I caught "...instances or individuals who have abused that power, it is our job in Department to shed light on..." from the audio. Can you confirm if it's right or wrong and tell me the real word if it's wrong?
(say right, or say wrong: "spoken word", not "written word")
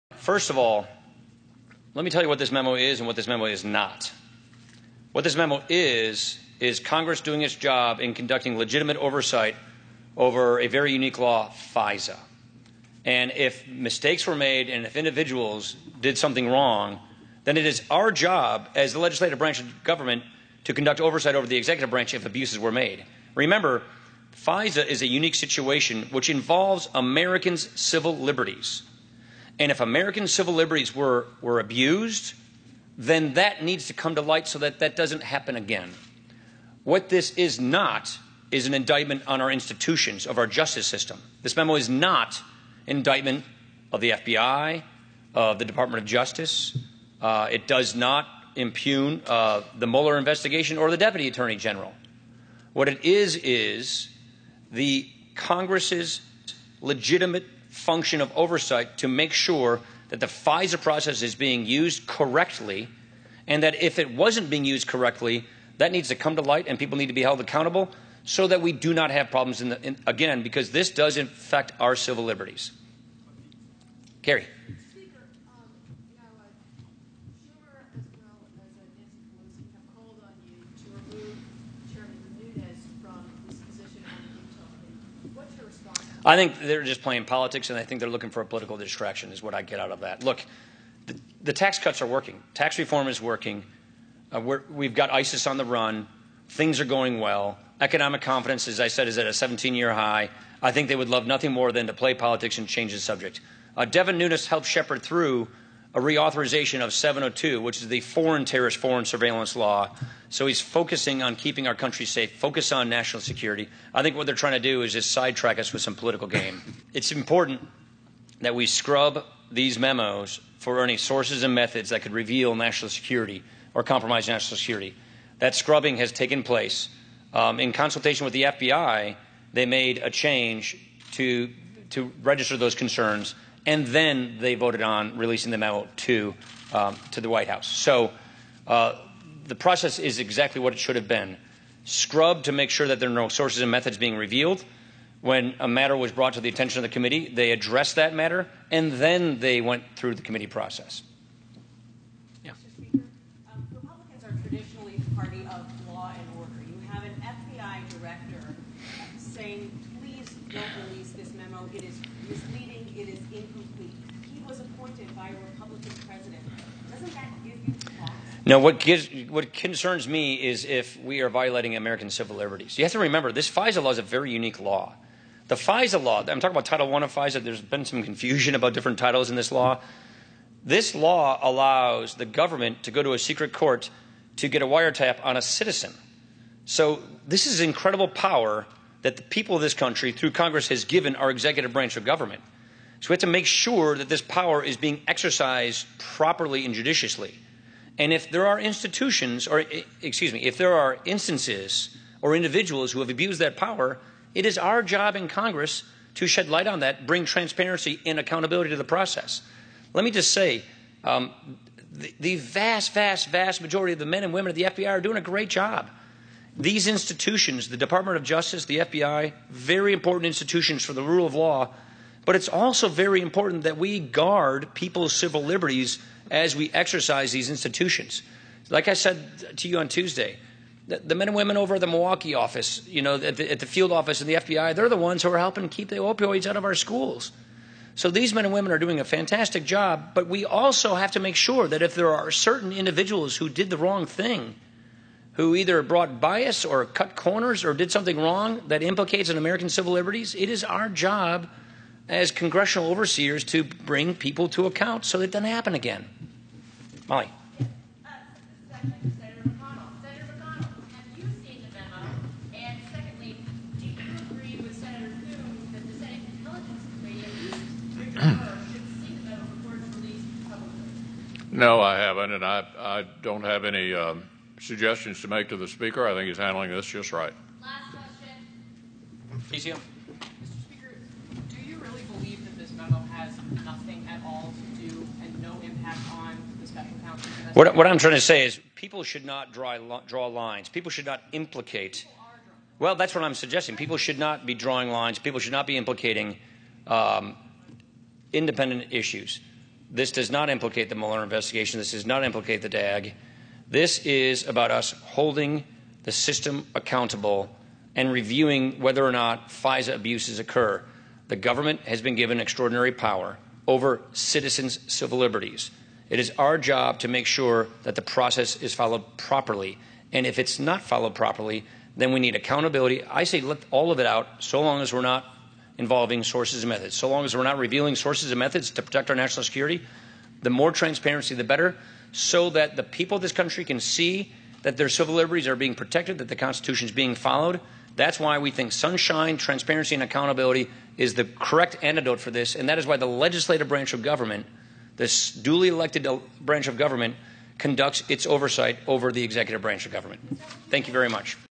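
wrong: "Congress", not "Department".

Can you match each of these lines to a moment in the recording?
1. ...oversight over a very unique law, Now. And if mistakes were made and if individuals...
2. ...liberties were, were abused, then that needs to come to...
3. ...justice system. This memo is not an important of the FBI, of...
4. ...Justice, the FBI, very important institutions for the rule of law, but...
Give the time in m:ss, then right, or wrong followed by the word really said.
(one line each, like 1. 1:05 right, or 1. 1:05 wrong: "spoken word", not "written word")
1. 0:08 wrong: "FISA", not "Now"
2. 0:30 right
3. 0:40 wrong: "indictment", not "important"
4. 3:38 right.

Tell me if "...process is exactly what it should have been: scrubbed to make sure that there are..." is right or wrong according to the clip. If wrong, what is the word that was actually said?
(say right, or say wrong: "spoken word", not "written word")
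right.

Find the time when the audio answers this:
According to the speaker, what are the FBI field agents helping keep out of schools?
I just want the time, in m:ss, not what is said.
3:55.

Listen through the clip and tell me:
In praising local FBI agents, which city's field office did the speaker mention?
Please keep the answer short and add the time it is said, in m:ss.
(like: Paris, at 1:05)
Milwaukee, at 3:51.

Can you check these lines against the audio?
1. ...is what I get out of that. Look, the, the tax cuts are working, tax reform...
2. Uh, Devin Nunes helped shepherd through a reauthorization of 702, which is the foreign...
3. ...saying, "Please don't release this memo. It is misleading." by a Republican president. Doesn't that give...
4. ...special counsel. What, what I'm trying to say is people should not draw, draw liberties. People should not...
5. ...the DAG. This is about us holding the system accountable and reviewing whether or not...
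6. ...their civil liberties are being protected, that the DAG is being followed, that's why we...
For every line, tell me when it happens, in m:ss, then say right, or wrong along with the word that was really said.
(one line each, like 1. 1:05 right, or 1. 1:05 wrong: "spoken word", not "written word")
1. 1:29 right
2. 1:43 right
3. 2:39 right
4. 4:46 wrong: "lines", not "liberties"
5. 5:02 right
6. 5:34 wrong: "Constitution", not "DAG".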